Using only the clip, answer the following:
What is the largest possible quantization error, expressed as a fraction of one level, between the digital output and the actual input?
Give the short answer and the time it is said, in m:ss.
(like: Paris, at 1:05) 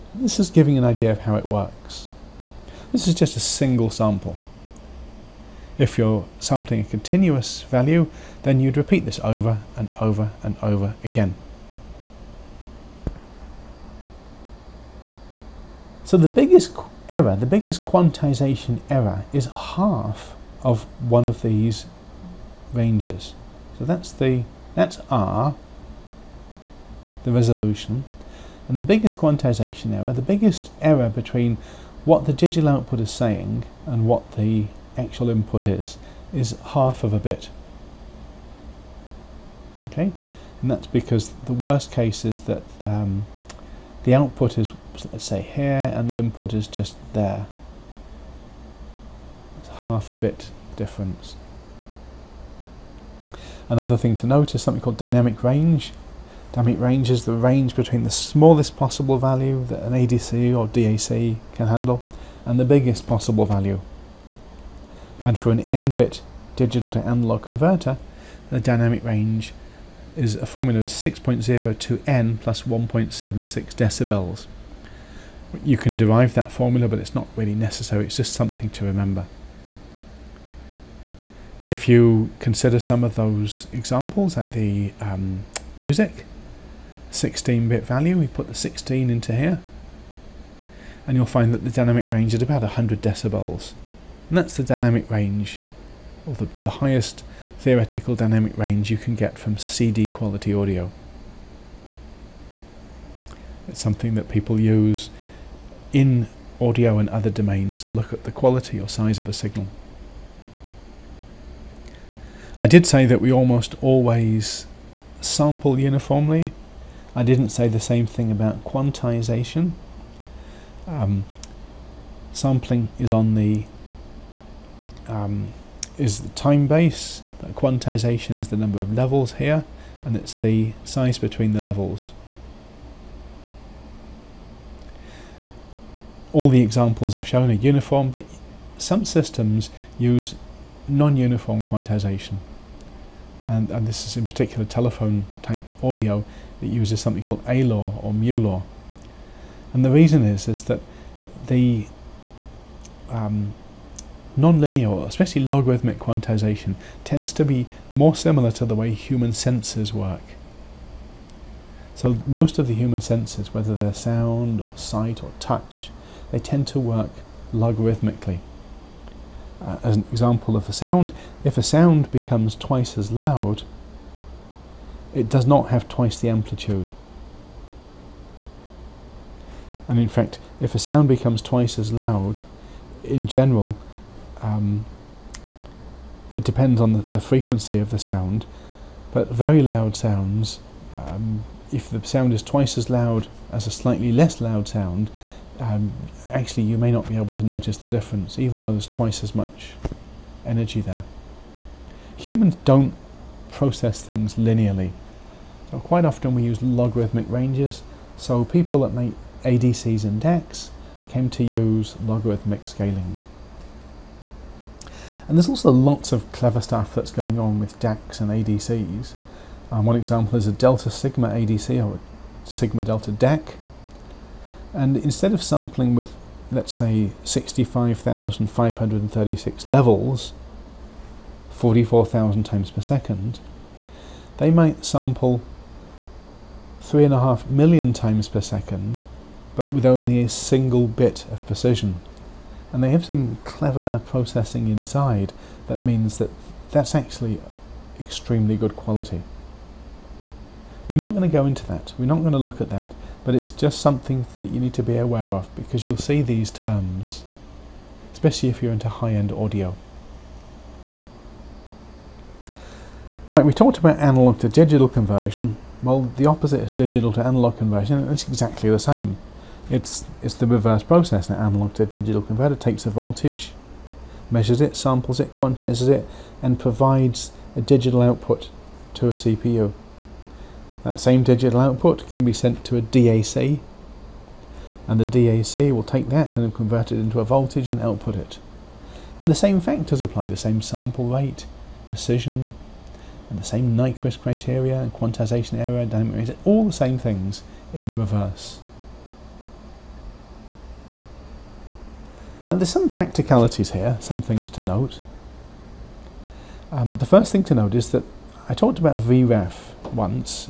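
Half a bit, at 0:36.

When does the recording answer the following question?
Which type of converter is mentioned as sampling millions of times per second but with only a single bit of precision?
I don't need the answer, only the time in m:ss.
3:40.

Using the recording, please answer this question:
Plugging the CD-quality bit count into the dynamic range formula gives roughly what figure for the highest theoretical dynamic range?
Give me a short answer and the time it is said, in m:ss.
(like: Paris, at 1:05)
100 decibels, at 1:32.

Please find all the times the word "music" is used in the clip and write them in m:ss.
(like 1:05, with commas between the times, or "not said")
1:25.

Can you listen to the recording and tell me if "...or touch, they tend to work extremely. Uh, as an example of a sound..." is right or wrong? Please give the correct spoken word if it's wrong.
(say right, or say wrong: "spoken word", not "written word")
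wrong: "logarithmically", not "extremely".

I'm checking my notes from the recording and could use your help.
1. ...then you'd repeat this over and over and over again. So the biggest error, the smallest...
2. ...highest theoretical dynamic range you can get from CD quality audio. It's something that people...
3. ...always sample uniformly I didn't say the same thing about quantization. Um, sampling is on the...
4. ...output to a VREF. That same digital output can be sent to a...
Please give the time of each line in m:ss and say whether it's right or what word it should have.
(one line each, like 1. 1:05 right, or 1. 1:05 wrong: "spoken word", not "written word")
1. 0:08 wrong: "biggest", not "smallest"
2. 1:36 right
3. 1:53 right
4. 4:38 wrong: "CPU", not "VREF".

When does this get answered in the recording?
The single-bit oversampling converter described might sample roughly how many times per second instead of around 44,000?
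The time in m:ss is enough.
3:56.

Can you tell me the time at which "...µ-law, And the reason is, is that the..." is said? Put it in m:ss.
2:28.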